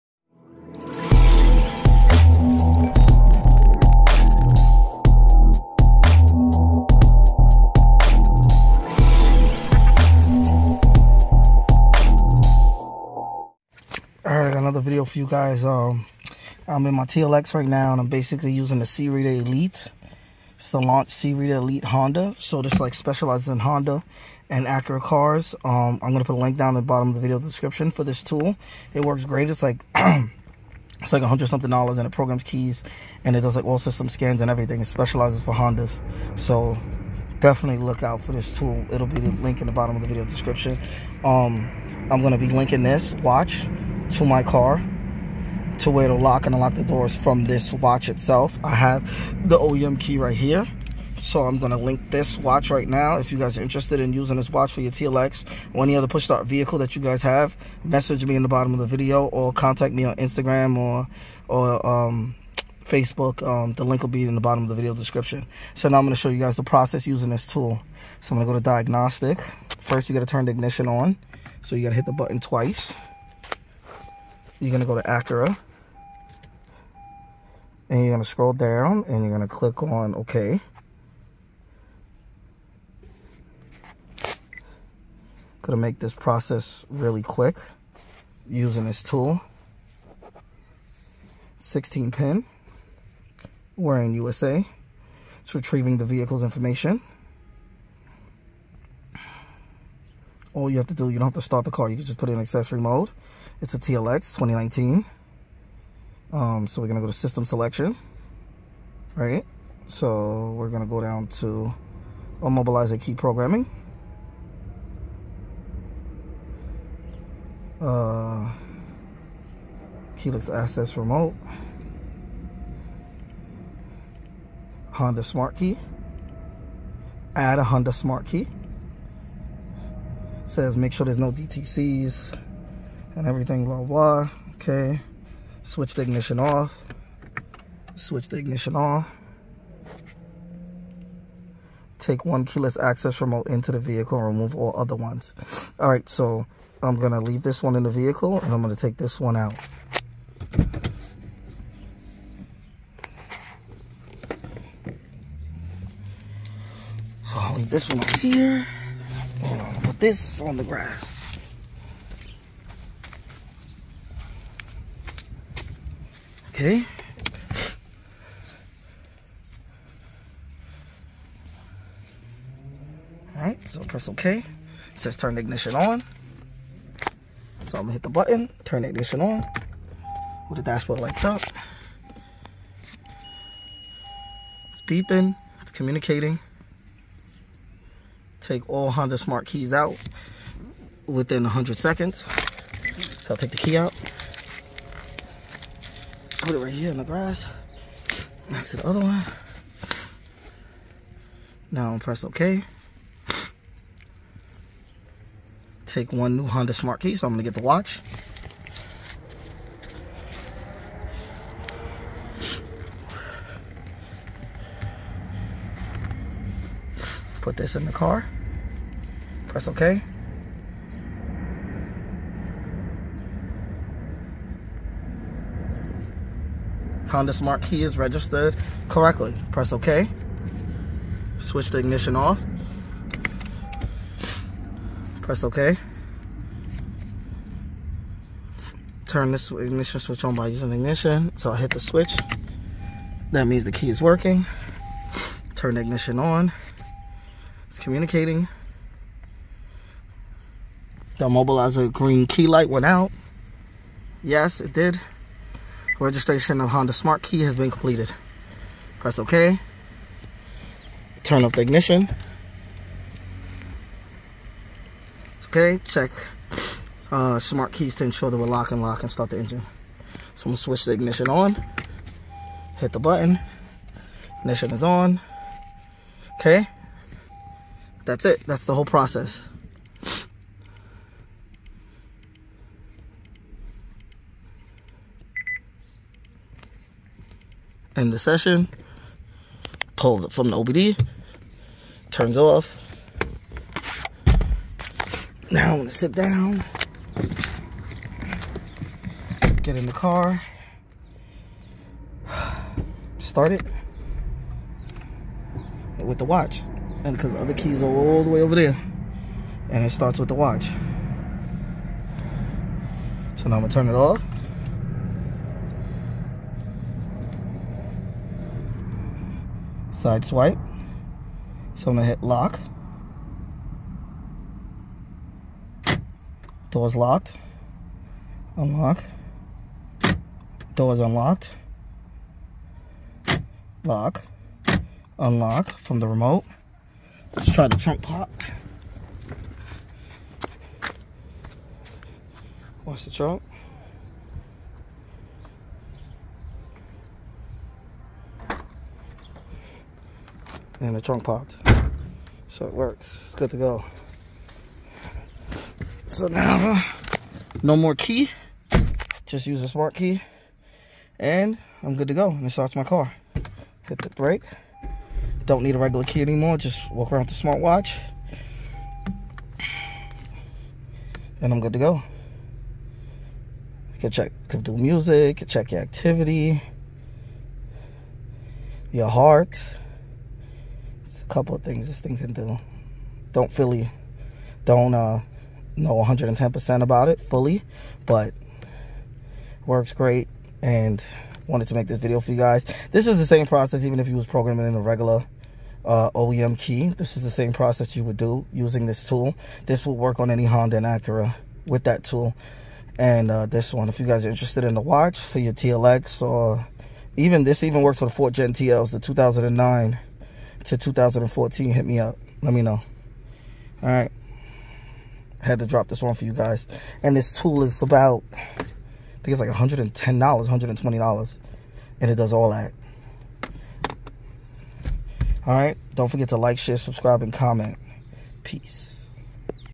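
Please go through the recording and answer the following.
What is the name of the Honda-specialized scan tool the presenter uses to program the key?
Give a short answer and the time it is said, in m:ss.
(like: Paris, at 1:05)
Launch C-Reader Elite Honda, at 0:20.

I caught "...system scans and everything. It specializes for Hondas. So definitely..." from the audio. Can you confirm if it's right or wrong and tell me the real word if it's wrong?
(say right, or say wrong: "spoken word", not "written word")
right.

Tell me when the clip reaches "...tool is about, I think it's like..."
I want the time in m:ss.
6:57.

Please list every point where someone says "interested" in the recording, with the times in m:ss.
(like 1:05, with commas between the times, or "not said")
0:53, 6:44.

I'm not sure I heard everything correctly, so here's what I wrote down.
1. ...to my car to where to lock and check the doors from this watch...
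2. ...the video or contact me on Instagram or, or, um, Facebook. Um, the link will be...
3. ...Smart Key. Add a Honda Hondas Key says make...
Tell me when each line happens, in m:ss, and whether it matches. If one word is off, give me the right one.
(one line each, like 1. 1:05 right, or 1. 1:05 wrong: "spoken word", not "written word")
1. 0:44 wrong: "unlock", not "check"
2. 0:58 right
3. 2:05 wrong: "Smart", not "Hondas".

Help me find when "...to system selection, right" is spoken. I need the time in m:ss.
1:47.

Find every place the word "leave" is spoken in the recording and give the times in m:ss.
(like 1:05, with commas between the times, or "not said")
2:27, 2:37.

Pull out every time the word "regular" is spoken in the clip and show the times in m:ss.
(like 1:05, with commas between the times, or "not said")
6:05, 6:34.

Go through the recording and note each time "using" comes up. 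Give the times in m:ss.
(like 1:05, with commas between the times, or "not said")
0:18, 0:54, 1:07, 1:28, 4:00, 6:38.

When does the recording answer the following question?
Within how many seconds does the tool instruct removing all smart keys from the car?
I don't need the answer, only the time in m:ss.
3:11.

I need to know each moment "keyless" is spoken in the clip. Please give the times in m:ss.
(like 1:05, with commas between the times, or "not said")
2:00, 2:22.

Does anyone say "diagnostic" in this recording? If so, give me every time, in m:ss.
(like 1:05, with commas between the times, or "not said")
1:08.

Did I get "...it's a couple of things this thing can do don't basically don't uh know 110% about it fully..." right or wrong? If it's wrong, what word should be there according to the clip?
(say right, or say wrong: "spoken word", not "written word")
wrong: "fully", not "basically".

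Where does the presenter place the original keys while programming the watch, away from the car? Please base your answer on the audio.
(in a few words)
In the grass.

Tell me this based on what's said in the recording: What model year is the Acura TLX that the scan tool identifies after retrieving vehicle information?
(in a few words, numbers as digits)
2019.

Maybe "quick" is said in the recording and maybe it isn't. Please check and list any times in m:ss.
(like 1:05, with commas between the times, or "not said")
1:27.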